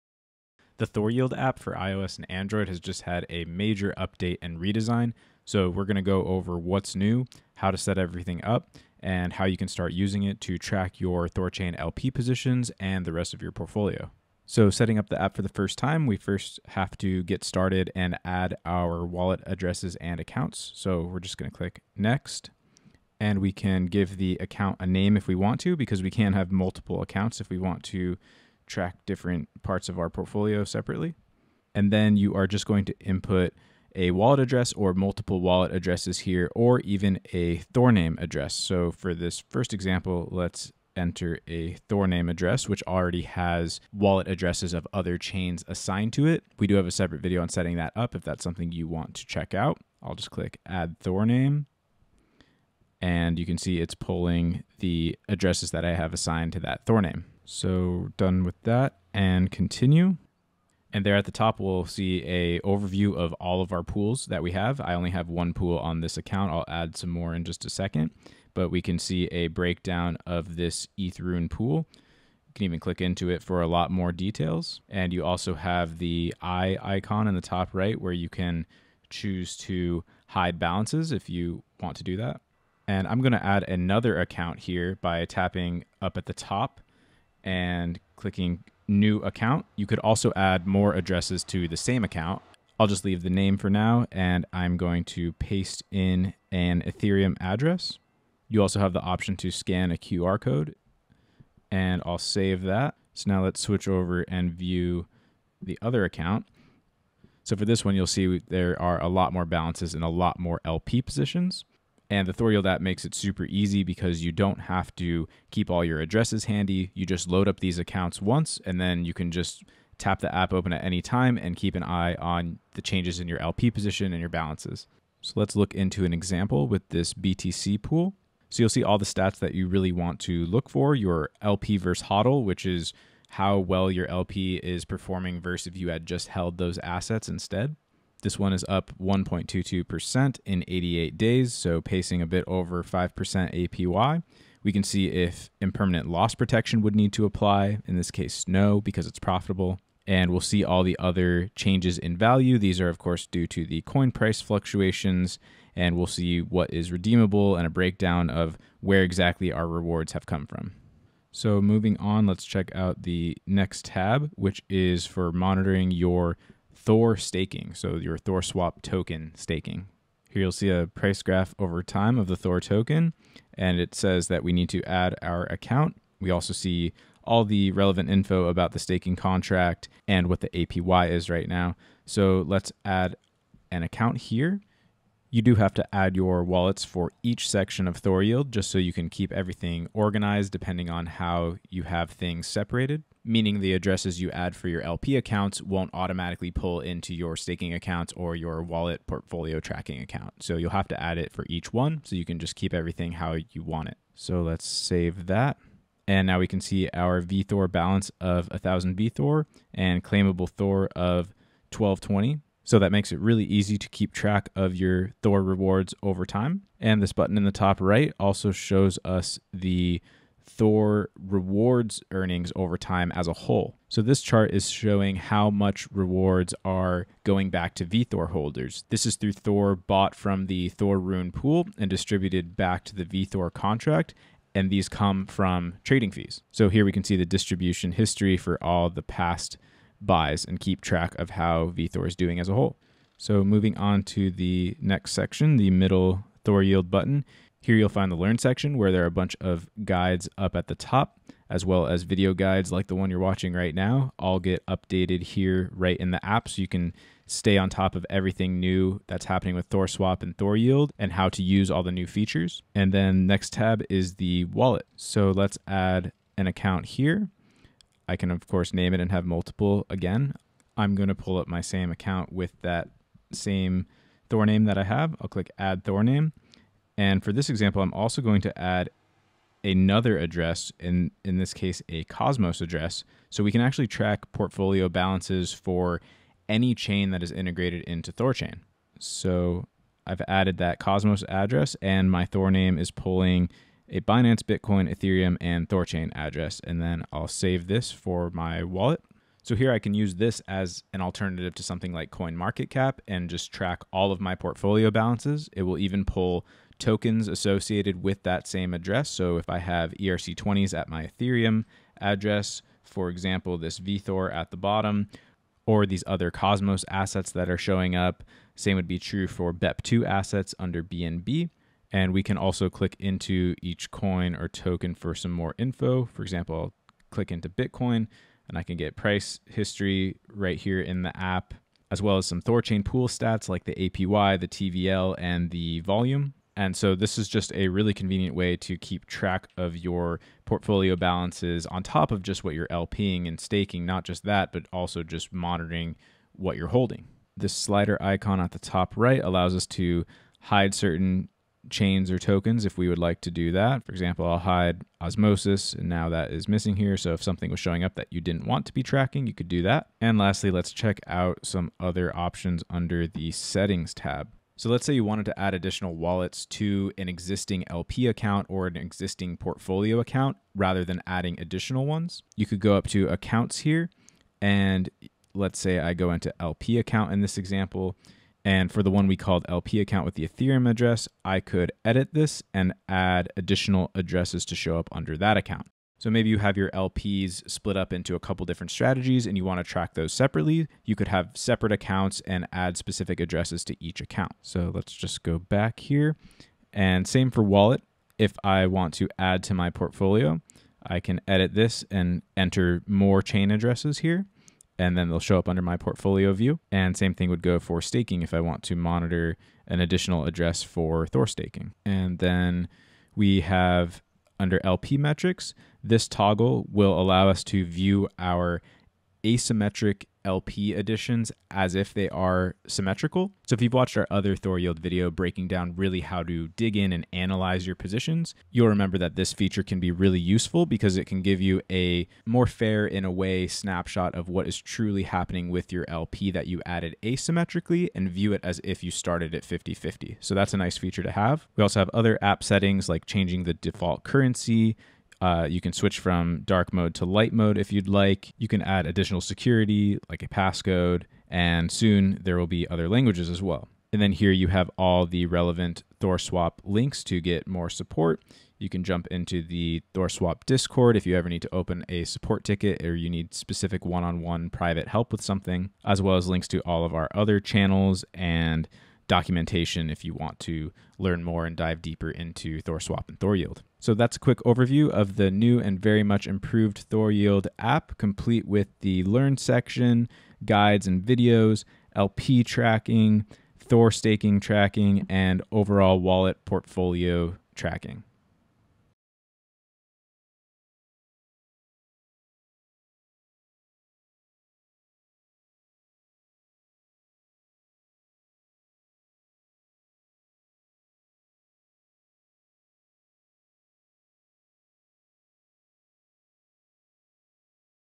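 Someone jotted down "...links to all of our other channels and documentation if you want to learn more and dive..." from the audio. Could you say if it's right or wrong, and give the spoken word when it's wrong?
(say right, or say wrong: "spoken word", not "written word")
right.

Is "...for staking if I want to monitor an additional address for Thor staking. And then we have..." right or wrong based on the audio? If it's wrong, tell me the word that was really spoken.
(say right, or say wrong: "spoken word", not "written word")
right.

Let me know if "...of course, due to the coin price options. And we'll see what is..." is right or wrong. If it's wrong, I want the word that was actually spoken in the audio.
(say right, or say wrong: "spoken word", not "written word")
wrong: "fluctuations", not "options".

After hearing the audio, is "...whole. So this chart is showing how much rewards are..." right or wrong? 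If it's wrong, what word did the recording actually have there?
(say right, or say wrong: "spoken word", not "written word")
right.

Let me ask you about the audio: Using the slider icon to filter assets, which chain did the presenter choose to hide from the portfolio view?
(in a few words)
Osmosis.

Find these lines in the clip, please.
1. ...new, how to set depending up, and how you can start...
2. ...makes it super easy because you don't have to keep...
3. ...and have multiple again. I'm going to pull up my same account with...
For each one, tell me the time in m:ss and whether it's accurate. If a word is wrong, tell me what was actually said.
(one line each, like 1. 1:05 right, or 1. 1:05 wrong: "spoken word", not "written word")
1. 0:06 wrong: "everything", not "depending"
2. 1:52 right
3. 4:28 right.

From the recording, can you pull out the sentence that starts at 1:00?
And there at the top, we'll see a overview of all of our pools that we have.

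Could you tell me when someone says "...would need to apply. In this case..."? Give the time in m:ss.
2:26.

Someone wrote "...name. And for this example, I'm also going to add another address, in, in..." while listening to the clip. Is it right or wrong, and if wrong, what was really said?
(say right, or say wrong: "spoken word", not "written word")
right.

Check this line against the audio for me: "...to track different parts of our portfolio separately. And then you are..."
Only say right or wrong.
right.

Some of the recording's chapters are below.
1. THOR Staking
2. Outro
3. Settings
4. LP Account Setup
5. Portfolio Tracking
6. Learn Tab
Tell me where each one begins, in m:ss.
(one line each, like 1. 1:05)
1. 2:41
2. 7:53
3. 5:59
4. 0:14
5. 4:22
6. 4:02.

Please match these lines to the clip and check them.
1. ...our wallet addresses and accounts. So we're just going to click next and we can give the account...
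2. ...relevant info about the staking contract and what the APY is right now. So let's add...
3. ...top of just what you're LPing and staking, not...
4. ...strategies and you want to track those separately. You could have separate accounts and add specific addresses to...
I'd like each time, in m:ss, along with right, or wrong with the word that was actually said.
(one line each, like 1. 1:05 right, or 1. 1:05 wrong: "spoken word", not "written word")
1. 0:18 right
2. 2:57 right
3. 5:41 right
4. 6:28 right.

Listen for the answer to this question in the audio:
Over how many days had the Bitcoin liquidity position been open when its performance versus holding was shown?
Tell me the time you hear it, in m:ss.
2:20.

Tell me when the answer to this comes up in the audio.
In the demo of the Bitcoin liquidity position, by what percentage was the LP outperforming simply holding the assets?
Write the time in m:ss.
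2:19.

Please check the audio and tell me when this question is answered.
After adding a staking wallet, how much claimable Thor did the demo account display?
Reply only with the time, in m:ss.
3:31.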